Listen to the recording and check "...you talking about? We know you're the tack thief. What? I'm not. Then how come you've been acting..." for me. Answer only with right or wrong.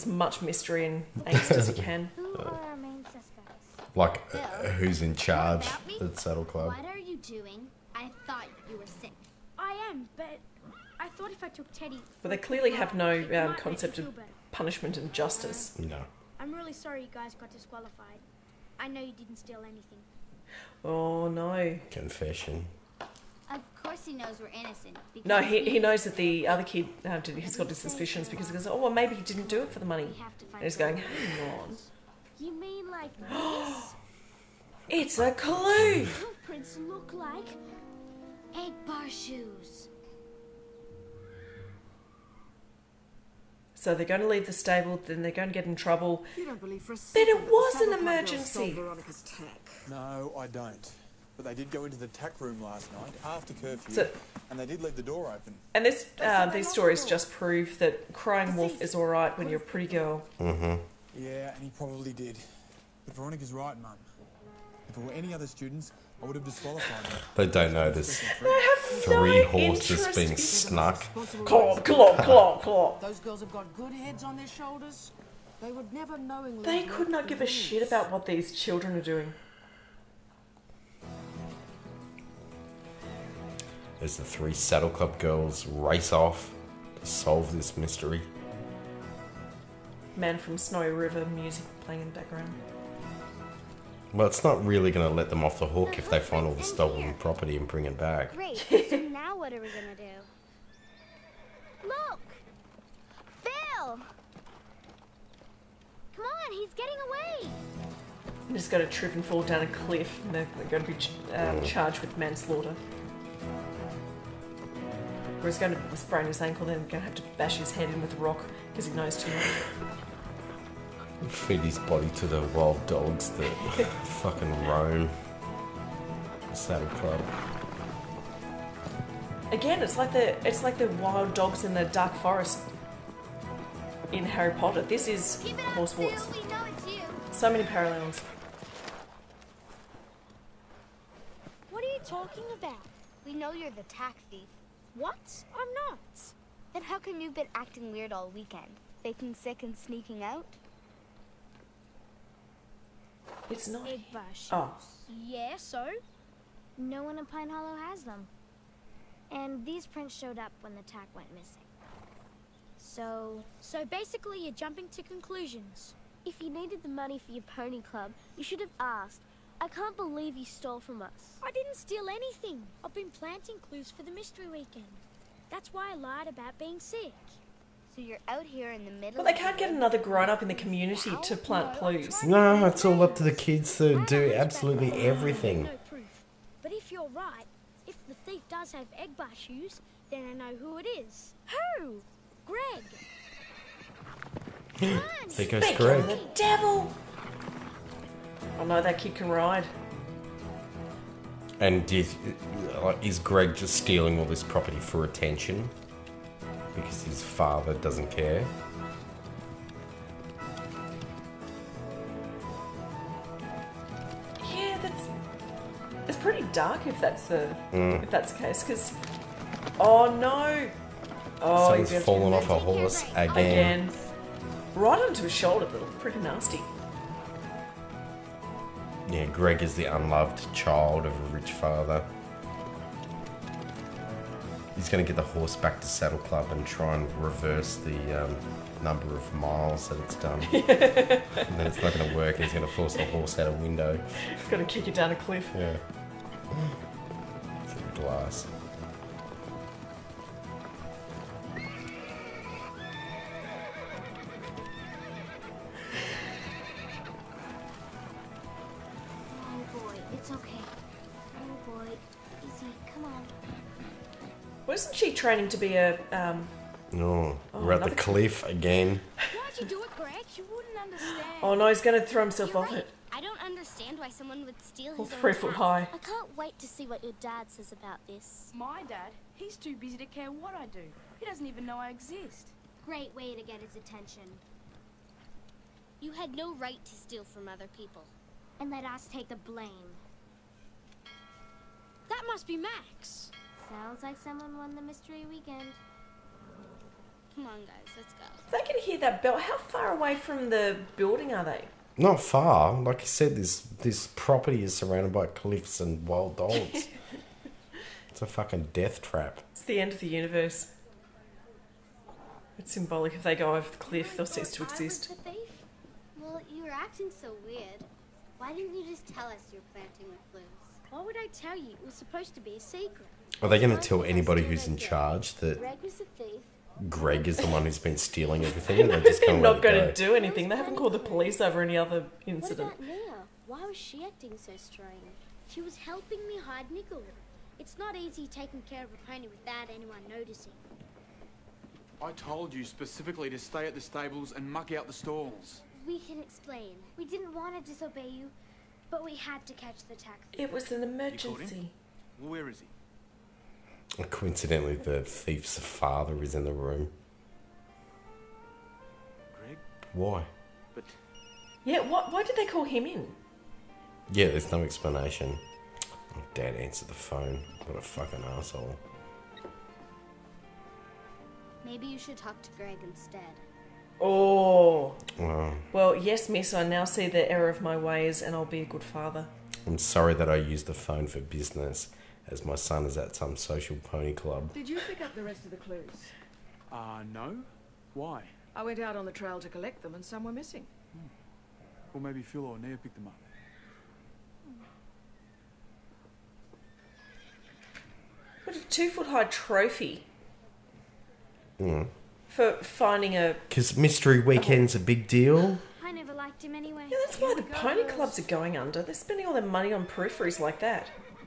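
right.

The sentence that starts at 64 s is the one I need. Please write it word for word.
If it were any other students, I would have disqualified him.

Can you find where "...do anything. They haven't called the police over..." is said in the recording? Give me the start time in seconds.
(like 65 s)
329 s.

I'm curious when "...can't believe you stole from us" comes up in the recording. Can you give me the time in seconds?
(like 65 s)
169 s.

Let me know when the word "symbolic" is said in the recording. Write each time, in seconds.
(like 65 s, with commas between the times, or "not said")
312 s.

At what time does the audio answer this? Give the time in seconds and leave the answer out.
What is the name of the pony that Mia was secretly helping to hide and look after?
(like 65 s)
336 s.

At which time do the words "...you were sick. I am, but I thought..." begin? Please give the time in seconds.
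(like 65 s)
8 s.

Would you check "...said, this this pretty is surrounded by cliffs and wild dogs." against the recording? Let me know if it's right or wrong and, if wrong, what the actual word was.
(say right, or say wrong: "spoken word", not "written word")
wrong: "property", not "pretty".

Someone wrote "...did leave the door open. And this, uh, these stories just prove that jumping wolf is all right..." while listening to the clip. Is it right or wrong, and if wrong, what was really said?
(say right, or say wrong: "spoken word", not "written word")
wrong: "crying", not "jumping".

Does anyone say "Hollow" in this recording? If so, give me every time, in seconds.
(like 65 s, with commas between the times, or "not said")
157 s.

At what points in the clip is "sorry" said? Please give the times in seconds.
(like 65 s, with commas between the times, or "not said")
16 s, 379 s.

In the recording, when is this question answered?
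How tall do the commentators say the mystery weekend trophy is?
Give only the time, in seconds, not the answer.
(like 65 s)
398 s.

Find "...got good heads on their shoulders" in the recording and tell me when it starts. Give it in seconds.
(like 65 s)
73 s.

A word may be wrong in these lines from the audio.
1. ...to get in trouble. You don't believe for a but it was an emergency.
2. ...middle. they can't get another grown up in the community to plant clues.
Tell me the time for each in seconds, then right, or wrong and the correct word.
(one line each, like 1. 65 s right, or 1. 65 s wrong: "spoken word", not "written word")
1. 45 s right
2. 178 s right.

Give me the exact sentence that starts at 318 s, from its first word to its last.
Why didn't you just tell us you were planting with clues?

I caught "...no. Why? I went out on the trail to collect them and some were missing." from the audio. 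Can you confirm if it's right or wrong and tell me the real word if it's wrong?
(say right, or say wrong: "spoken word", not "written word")
right.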